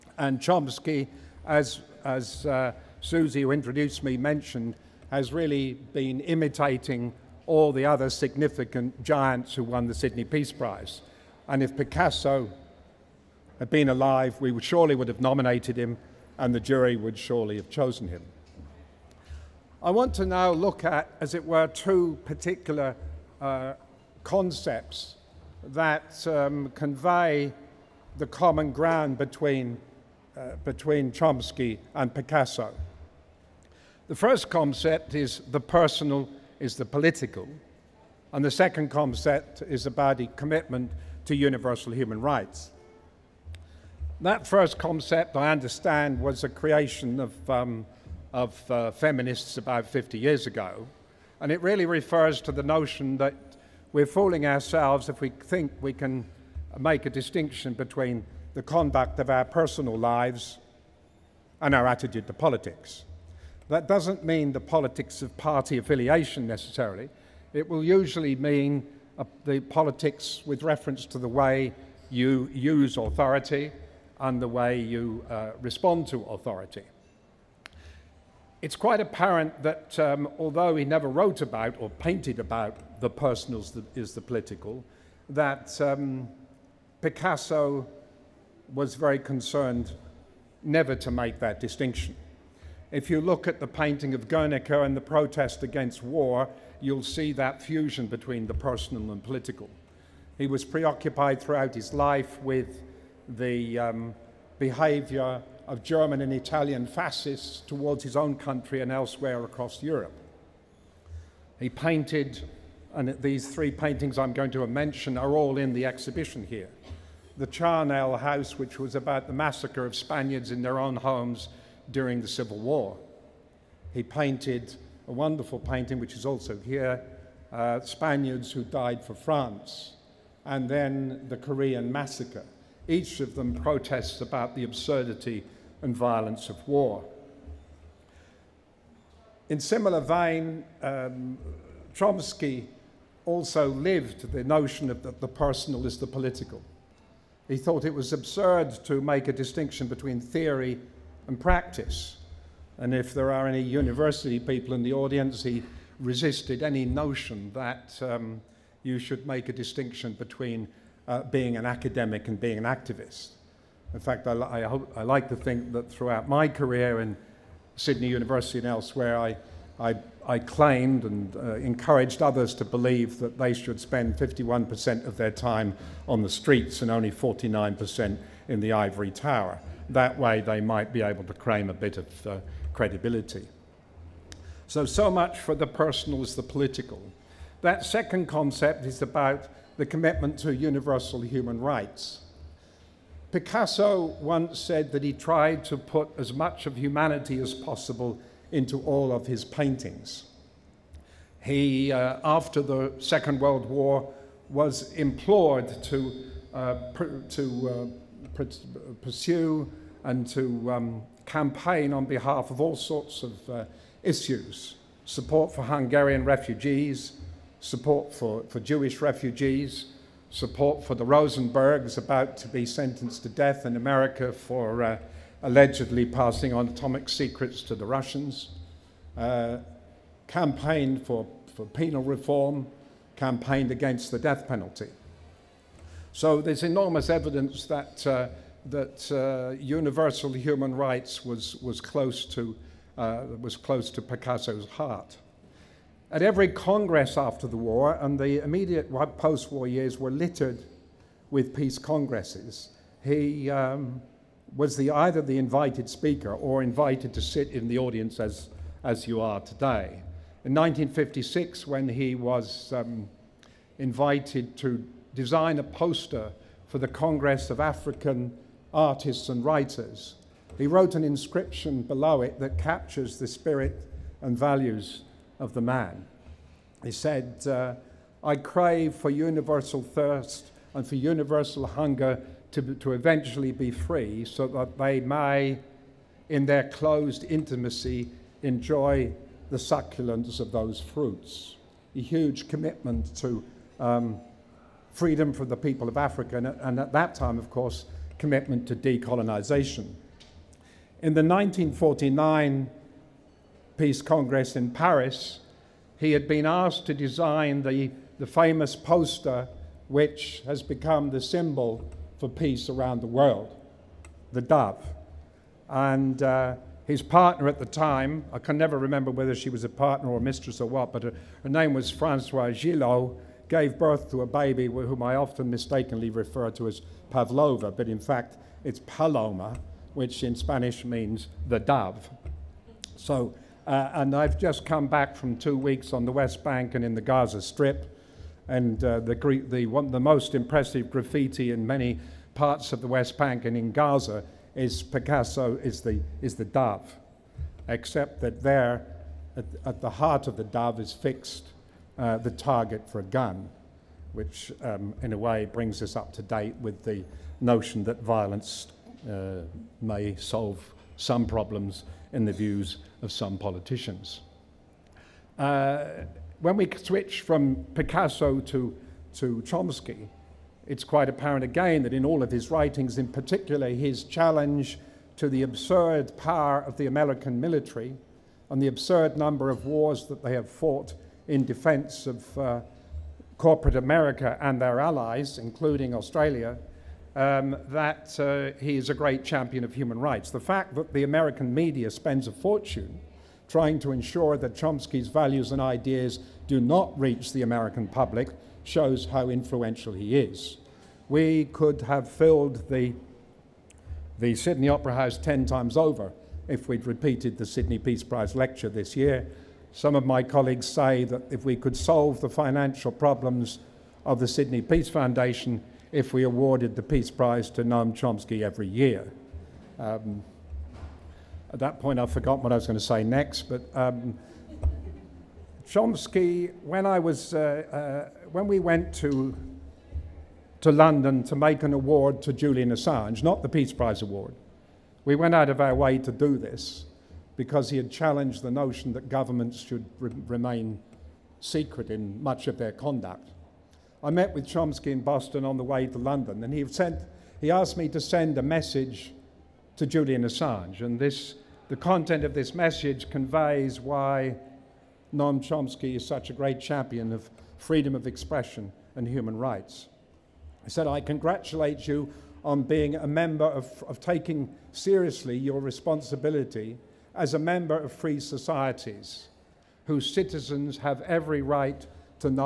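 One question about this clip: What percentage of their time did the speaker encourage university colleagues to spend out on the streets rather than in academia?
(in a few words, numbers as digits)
51%.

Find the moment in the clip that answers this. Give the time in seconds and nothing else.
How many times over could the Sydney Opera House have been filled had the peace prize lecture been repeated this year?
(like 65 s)
405 s.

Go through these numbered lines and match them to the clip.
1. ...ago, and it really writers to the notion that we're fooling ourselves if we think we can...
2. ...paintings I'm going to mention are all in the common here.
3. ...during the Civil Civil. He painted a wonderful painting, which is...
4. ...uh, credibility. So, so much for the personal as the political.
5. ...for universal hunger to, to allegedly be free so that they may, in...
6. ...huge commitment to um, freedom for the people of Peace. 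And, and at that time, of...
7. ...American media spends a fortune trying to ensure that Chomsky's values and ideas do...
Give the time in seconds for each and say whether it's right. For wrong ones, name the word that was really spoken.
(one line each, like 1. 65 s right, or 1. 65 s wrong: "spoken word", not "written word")
1. 50 s wrong: "refers", not "writers"
2. 113 s wrong: "exhibition", not "common"
3. 121 s wrong: "War", not "Civil"
4. 182 s right
5. 280 s wrong: "eventually", not "allegedly"
6. 292 s wrong: "Africa", not "Peace"
7. 391 s right.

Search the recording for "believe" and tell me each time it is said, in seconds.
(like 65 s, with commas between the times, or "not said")
172 s.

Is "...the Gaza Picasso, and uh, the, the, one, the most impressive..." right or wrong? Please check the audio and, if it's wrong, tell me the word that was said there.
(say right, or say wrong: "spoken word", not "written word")
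wrong: "Strip", not "Picasso".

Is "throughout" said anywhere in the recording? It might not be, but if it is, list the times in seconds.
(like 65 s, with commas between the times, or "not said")
101 s, 165 s.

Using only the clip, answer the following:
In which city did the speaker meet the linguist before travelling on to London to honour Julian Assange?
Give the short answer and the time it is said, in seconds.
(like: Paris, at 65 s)
Boston, at 445 s.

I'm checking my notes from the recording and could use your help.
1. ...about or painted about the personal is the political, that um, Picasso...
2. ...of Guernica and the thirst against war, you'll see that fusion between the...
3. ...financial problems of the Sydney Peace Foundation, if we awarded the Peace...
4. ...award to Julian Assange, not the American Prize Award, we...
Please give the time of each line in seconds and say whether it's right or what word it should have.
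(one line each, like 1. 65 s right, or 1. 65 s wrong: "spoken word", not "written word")
1. 81 s right
2. 94 s wrong: "protest", not "thirst"
3. 412 s right
4. 431 s wrong: "Peace", not "American".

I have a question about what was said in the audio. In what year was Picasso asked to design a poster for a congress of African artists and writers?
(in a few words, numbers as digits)
1956.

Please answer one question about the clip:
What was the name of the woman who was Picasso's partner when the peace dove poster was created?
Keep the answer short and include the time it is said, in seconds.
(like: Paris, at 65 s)
Francoise Gilot, at 321 s.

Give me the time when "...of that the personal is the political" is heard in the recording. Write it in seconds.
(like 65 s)
144 s.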